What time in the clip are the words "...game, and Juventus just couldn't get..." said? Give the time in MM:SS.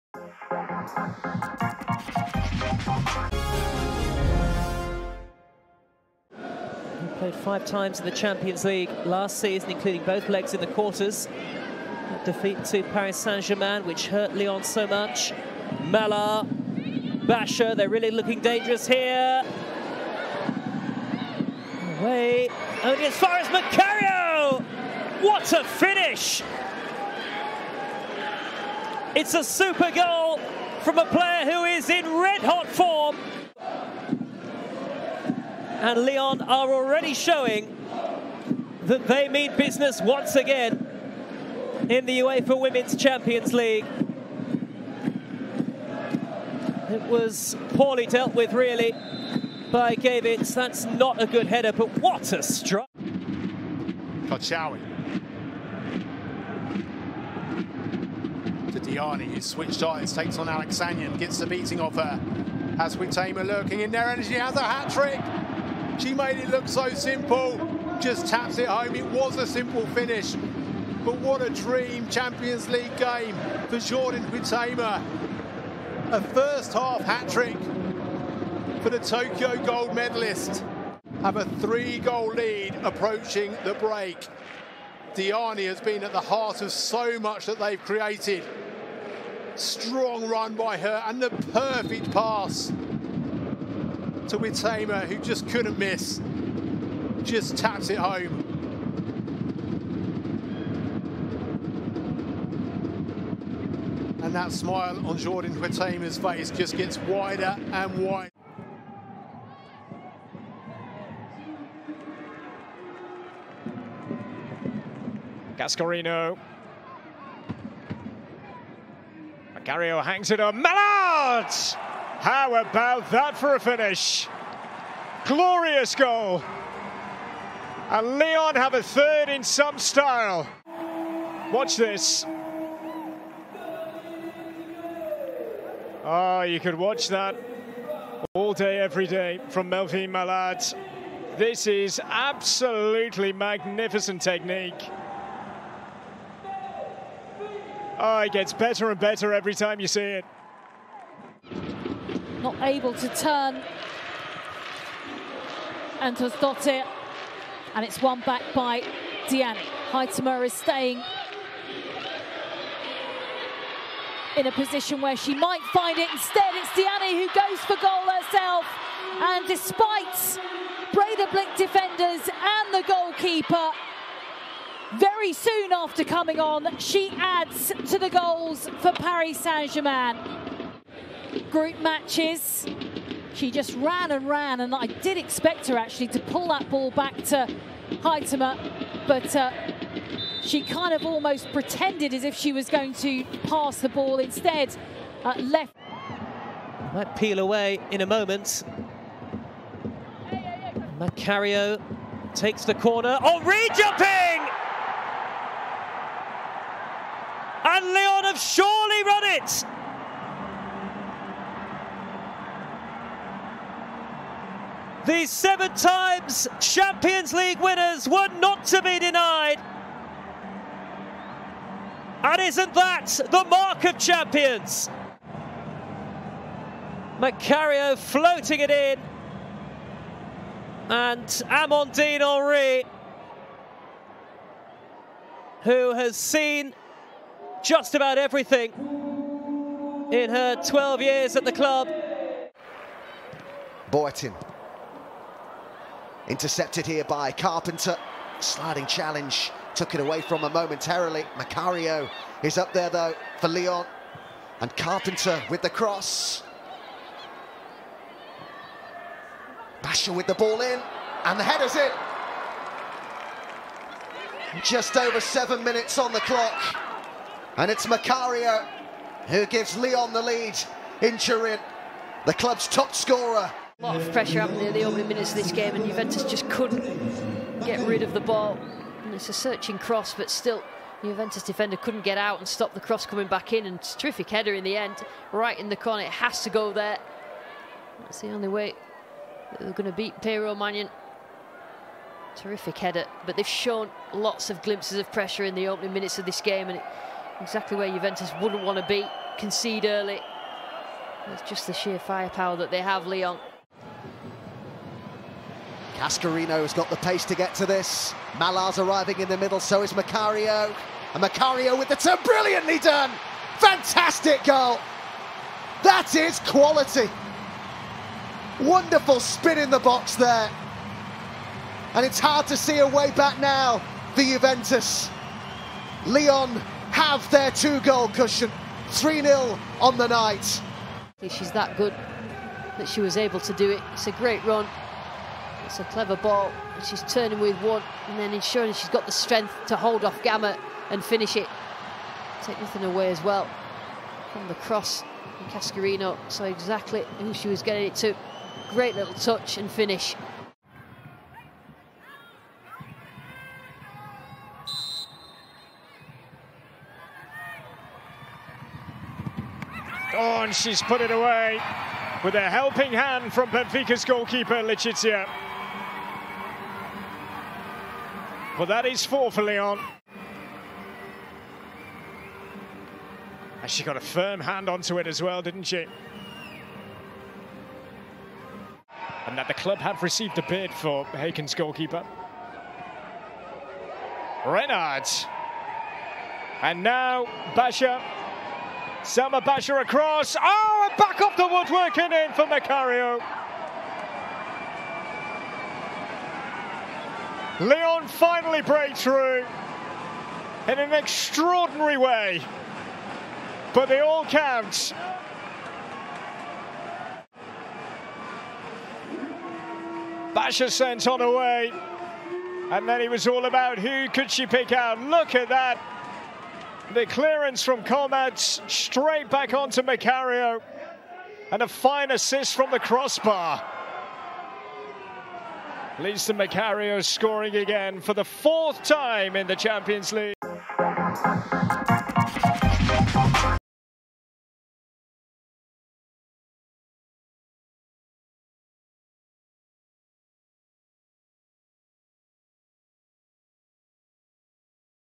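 04:35.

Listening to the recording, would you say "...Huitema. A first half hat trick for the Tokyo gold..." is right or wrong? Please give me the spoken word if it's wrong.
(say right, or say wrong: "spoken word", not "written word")
right.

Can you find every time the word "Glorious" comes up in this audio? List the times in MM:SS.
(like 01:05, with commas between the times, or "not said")
02:05.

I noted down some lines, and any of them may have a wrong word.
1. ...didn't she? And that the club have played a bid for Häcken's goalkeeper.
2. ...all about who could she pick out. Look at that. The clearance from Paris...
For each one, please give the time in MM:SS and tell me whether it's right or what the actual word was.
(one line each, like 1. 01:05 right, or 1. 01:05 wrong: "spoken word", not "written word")
1. 06:15 wrong: "received", not "played"
2. 06:53 wrong: "Comets", not "Paris".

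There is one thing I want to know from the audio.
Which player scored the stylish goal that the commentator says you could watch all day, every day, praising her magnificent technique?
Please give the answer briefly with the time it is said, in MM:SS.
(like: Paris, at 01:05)
Melvine Malard, at 02:19.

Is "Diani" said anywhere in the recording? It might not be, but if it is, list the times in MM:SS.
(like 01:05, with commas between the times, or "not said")
00:59, 01:25, 02:39, 02:46.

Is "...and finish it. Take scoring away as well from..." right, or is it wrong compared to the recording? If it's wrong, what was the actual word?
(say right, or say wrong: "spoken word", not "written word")
wrong: "nothing", not "scoring".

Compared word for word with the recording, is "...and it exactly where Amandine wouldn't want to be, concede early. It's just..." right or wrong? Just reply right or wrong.
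wrong.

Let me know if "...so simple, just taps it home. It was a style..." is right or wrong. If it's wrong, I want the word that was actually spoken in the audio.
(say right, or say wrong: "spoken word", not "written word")
wrong: "simple", not "style".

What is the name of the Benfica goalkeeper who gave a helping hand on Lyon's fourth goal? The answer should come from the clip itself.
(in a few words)
Leticia.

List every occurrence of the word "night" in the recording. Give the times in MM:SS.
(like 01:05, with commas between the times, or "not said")
05:30.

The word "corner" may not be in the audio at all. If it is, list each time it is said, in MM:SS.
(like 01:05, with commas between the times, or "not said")
03:22, 04:45.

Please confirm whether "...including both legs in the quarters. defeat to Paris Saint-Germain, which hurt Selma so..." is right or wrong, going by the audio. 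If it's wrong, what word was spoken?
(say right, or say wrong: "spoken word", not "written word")
wrong: "Lyon", not "Selma".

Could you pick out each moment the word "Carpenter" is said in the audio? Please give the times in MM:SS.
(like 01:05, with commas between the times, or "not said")
04:07, 04:14.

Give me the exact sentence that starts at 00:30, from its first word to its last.
from a player who is in red hot form.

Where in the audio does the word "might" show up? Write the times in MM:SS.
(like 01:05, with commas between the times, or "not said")
02:45, 03:16.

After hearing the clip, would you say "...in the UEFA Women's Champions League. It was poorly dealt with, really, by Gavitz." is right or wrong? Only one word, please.
right.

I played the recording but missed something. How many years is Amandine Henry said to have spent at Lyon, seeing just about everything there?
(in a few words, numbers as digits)
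12.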